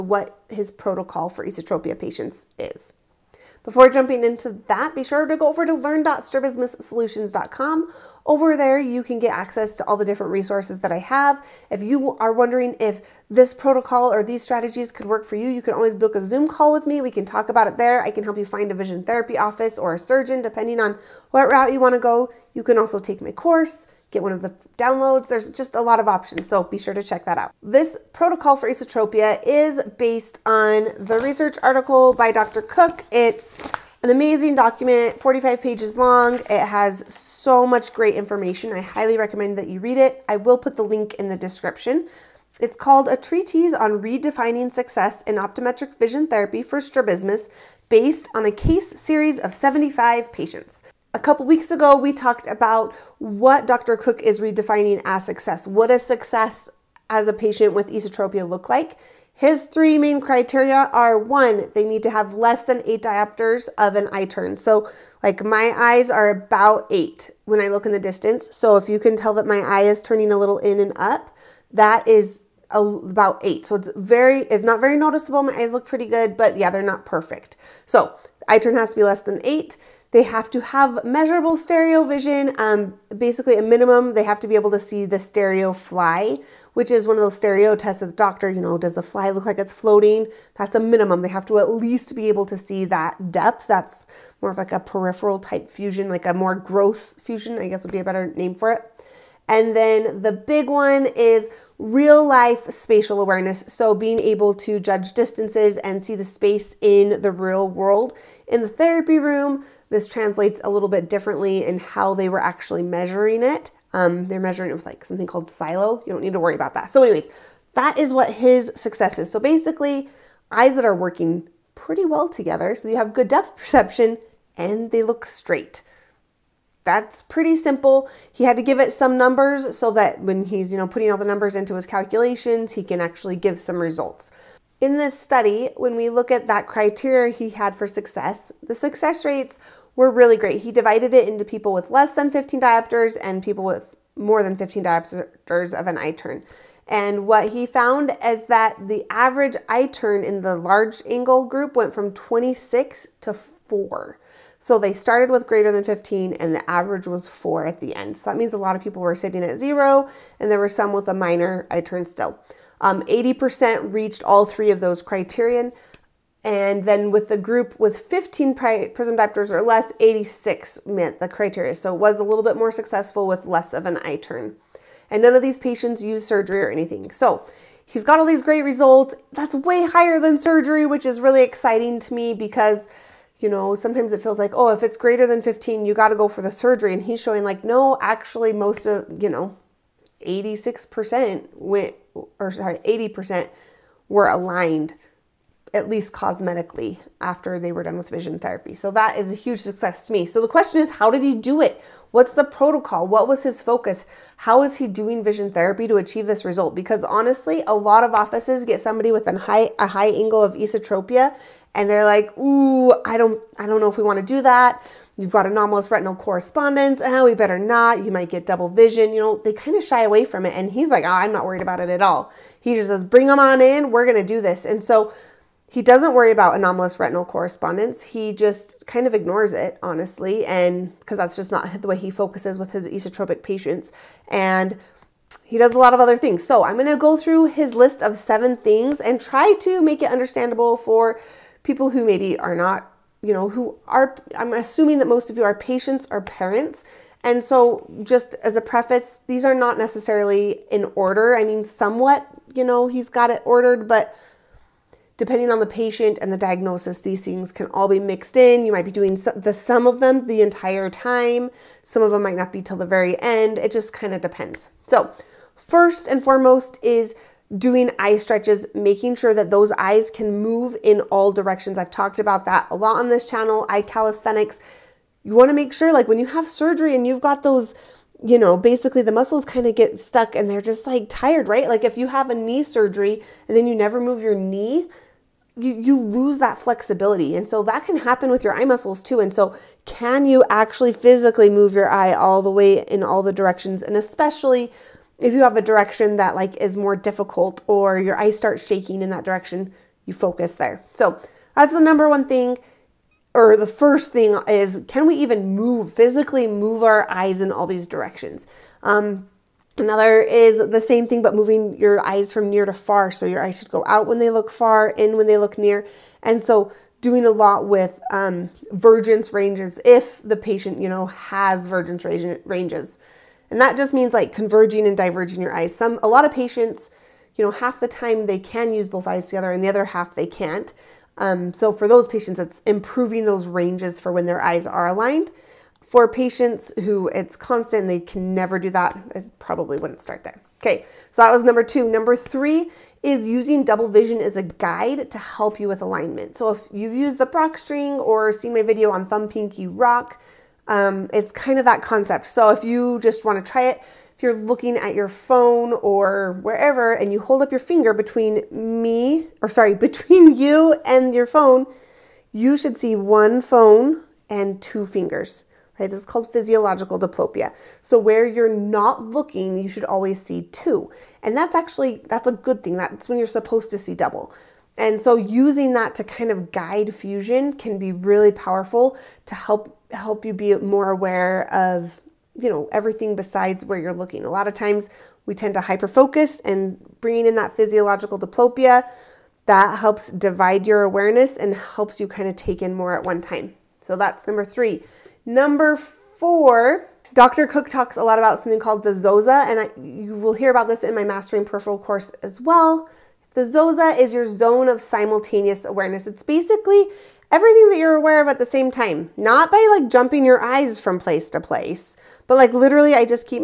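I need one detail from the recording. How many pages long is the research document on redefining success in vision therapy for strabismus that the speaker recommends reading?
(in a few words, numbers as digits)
45.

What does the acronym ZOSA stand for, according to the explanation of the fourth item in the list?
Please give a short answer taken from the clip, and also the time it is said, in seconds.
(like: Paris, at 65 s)
zone of simultaneous awareness, at 404 s.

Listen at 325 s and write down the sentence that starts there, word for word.
Some, a lot of patients, you know, half the time they can use both eyes together and the other half they can't.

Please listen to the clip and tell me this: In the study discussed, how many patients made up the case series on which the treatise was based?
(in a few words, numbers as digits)
75.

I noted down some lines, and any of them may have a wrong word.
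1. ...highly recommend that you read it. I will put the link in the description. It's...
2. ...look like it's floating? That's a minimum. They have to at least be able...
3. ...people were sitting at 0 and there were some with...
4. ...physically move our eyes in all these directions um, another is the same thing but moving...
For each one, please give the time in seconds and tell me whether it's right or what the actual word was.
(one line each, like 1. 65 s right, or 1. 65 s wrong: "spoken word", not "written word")
1. 38 s right
2. 89 s right
3. 158 s right
4. 305 s right.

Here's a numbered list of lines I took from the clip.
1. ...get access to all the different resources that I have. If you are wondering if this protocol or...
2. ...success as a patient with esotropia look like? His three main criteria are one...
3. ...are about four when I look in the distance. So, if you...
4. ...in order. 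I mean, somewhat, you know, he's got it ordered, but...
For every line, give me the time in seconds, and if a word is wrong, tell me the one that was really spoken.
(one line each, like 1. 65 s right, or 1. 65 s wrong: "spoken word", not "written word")
1. 9 s right
2. 56 s right
3. 66 s wrong: "eight", not "four"
4. 250 s right.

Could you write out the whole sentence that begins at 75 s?
My eyes look pretty good, but yeah, they're not perfect.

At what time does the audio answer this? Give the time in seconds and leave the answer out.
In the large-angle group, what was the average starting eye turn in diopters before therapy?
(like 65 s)
152 s.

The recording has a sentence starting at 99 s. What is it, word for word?
And then the big one is real life spatial awareness.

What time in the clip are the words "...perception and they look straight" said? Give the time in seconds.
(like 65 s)
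123 s.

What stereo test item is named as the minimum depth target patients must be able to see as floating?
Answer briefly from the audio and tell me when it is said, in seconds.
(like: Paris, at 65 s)
stereo fly, at 85 s.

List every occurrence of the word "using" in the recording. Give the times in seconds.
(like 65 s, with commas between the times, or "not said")
343 s, 375 s.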